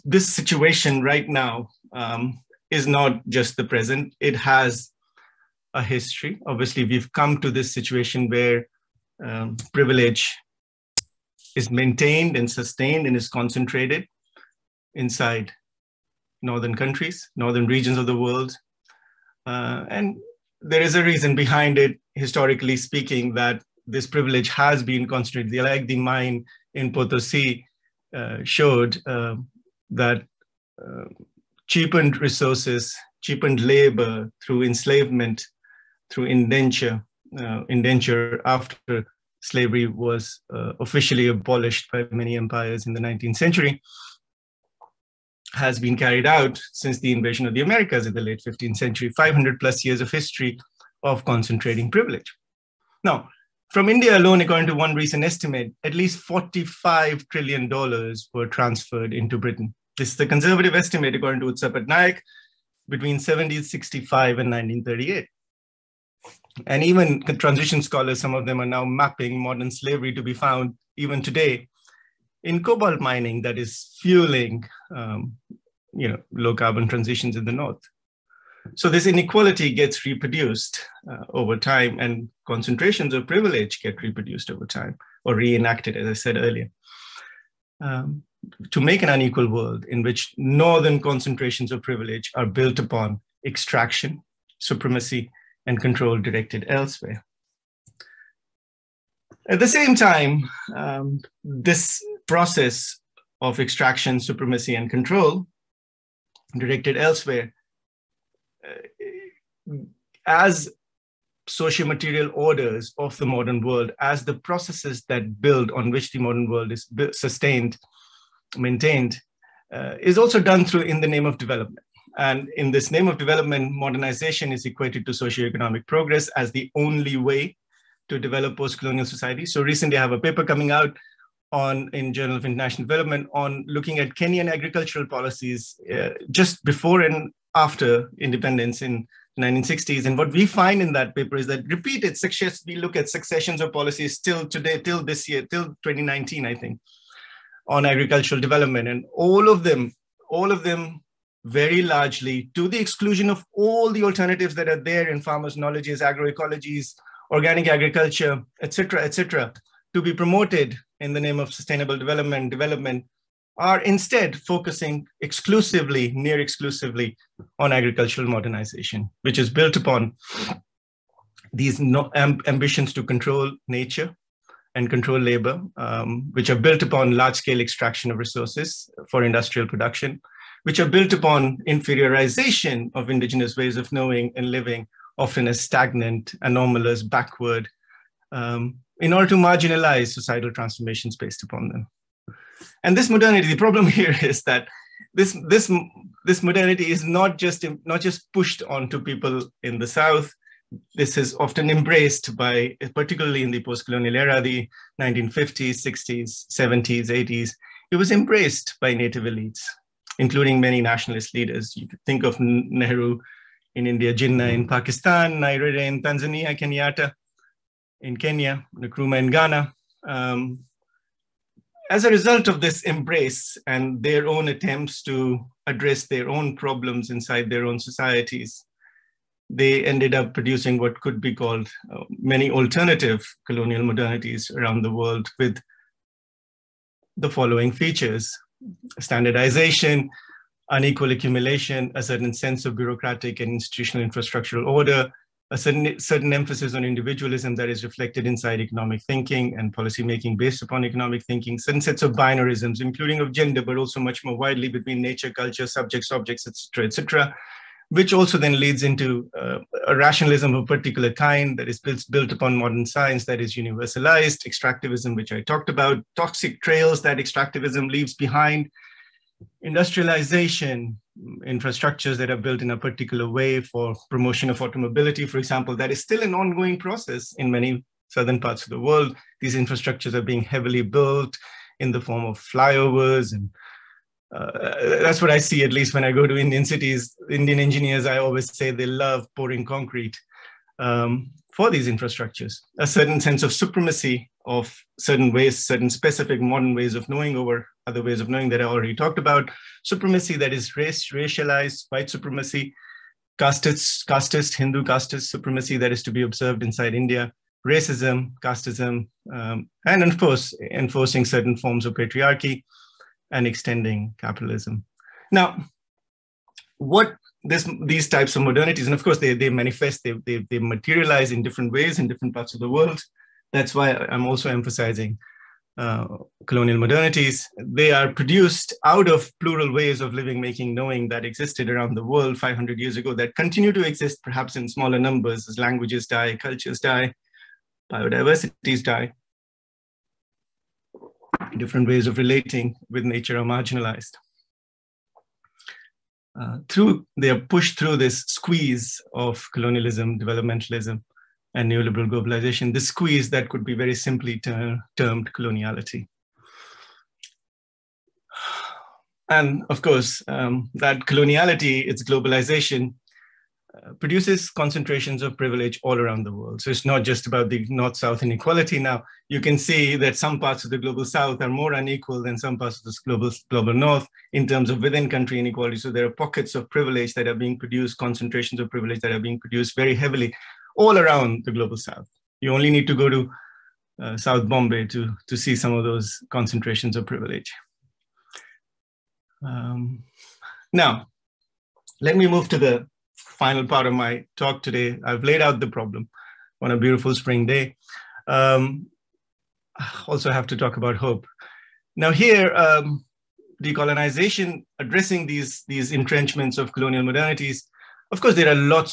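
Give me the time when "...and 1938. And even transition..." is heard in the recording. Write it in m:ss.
1:04.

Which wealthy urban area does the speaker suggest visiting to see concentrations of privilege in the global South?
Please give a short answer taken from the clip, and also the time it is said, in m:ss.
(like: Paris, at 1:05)
South Bombay, at 6:24.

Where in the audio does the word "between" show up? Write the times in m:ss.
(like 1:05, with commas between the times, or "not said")
1:02, 4:14.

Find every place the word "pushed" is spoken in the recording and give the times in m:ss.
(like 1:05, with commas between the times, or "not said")
3:18, 5:47.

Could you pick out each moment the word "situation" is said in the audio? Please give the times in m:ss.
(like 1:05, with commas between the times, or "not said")
0:00, 0:07.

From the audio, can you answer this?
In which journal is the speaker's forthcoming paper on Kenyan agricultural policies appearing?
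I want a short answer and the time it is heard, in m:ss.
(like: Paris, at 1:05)
Journal of International Development, at 2:12.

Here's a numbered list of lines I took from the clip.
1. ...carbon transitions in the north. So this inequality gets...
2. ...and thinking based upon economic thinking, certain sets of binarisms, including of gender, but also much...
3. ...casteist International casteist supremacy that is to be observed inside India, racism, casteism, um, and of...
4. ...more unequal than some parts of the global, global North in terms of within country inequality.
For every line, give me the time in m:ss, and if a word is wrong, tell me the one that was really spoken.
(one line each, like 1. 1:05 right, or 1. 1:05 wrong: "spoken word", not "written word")
1. 1:16 right
2. 4:09 wrong: "policymaking", not "thinking"
3. 5:04 wrong: "Hindu", not "International"
4. 6:11 right.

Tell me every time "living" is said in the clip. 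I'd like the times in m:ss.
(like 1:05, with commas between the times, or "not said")
3:04, 5:30.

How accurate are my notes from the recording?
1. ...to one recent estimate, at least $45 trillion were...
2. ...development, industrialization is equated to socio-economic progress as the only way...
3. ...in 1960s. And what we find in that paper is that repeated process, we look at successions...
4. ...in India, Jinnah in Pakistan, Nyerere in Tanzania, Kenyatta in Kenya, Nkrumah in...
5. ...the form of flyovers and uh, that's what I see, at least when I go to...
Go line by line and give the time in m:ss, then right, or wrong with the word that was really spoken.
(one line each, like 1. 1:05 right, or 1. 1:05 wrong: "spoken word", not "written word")
1. 0:54 right
2. 2:03 wrong: "modernization", not "industrialization"
3. 2:18 wrong: "success", not "process"
4. 3:33 right
5. 4:41 right.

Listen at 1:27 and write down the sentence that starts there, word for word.
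Um, to make an unequal world in which northern concentrations of privilege are built upon extraction, supremacy, and control directed elsewhere.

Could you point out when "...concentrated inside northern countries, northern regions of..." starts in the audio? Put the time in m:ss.
0:13.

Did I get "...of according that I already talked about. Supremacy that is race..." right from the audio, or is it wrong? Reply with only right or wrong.
wrong.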